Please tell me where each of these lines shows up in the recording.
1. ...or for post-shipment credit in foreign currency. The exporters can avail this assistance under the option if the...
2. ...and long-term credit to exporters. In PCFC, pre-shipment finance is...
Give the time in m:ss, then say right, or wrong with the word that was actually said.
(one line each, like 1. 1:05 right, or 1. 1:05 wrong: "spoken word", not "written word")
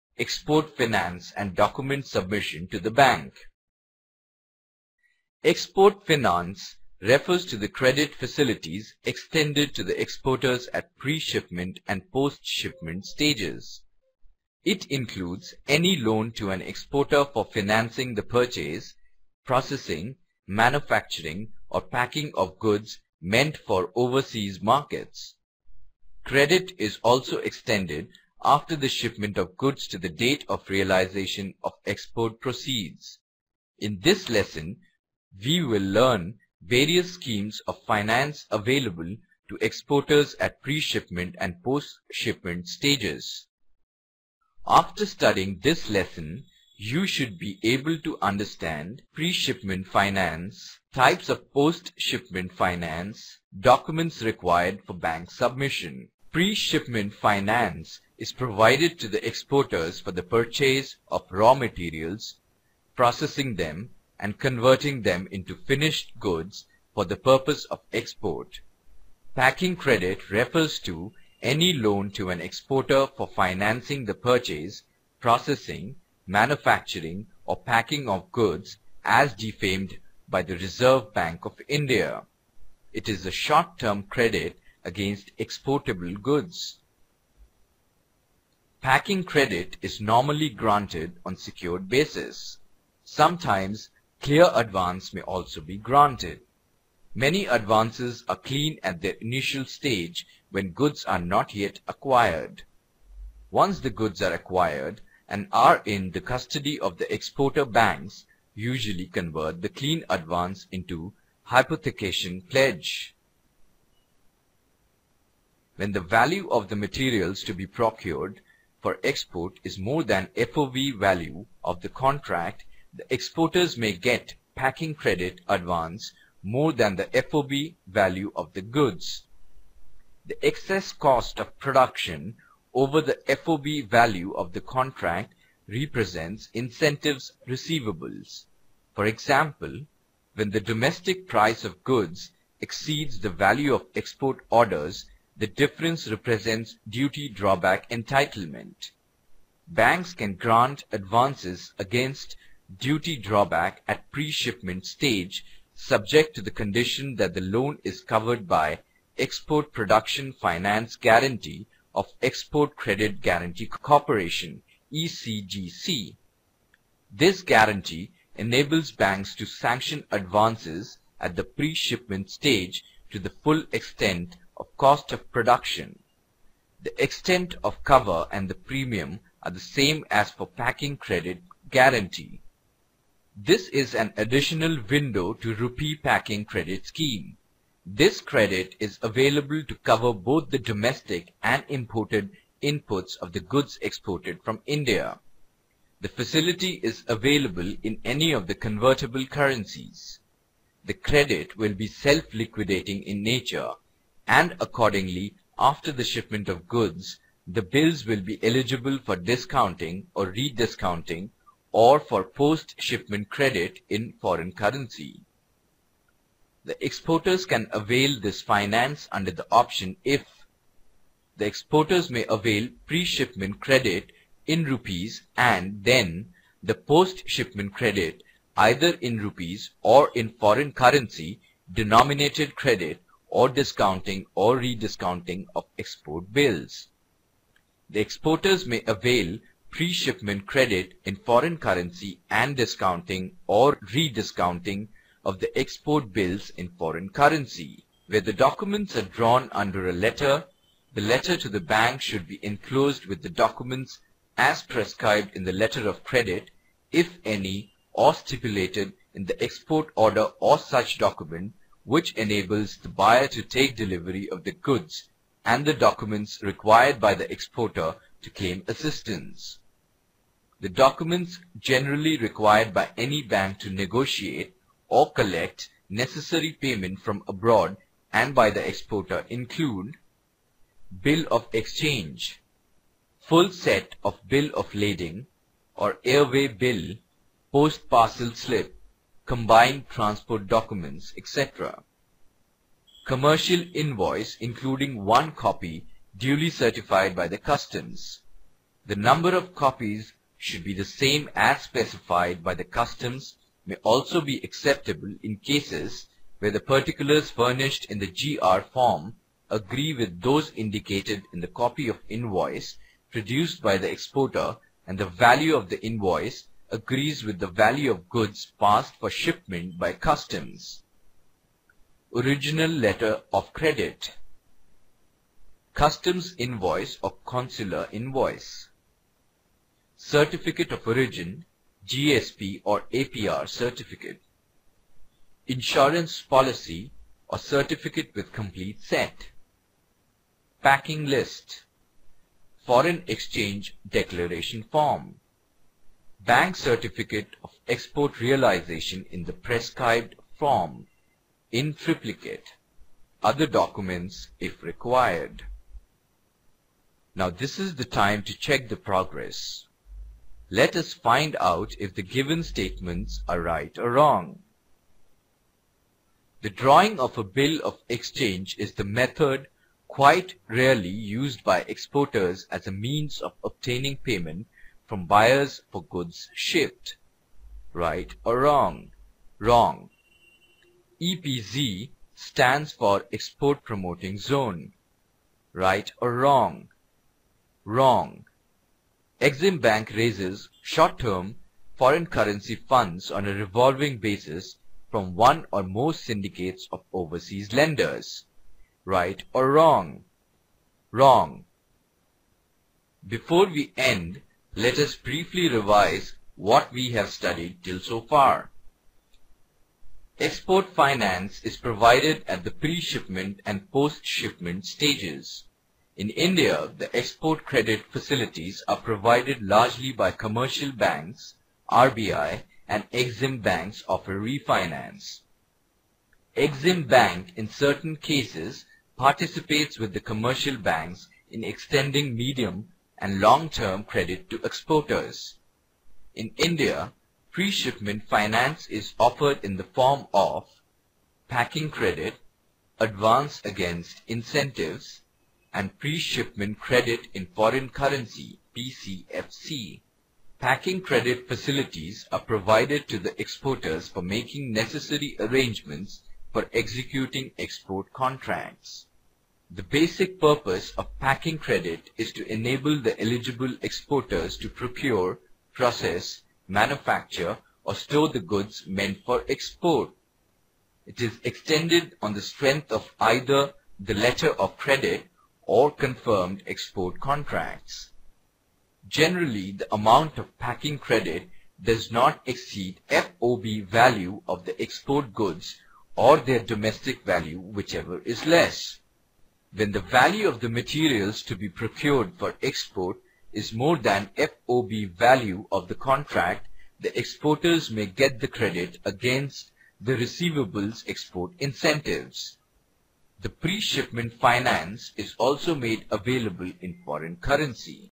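1. 3:31 wrong: "finance", not "assistance"
2. 7:13 wrong: "India", not "PCFC".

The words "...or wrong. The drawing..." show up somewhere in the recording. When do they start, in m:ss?
6:03.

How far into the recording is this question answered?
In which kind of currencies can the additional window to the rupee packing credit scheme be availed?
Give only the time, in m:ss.
3:18.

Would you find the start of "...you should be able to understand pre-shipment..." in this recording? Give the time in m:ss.
0:46.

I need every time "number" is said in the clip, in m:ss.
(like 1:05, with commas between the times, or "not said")
4:58.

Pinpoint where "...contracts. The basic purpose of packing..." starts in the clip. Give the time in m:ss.
7:37.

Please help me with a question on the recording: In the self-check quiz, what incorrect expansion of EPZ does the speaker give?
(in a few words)
Export Promoting Zone.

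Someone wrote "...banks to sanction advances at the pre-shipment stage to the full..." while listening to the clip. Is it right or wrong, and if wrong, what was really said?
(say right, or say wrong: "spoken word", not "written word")
right.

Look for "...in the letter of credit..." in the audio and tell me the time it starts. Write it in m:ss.
4:15.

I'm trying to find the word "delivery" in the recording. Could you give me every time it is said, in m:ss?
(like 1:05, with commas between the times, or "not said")
4:23.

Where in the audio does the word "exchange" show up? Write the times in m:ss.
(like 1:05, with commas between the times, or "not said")
4:41, 5:43, 6:07.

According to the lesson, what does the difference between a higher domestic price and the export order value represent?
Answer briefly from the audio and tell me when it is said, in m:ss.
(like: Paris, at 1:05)
duty drawback entitlement, at 2:26.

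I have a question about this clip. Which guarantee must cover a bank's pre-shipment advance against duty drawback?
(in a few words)
Export Production Finance Guarantee.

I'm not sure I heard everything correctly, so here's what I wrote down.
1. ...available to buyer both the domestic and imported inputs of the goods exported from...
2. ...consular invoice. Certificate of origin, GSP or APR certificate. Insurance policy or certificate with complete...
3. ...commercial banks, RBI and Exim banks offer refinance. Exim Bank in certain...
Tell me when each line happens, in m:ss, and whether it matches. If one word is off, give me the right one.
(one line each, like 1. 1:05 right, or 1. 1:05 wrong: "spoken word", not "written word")
1. 3:09 wrong: "cover", not "buyer"
2. 5:27 right
3. 7:00 right.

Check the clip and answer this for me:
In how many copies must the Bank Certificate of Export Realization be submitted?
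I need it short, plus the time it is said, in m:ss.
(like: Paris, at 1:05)
3 (triplicate), at 5:51.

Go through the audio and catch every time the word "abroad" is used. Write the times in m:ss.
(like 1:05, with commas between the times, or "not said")
4:37.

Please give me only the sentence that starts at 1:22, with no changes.
It is a short-term credit against exportable goods.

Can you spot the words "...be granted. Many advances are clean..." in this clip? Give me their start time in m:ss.
1:35.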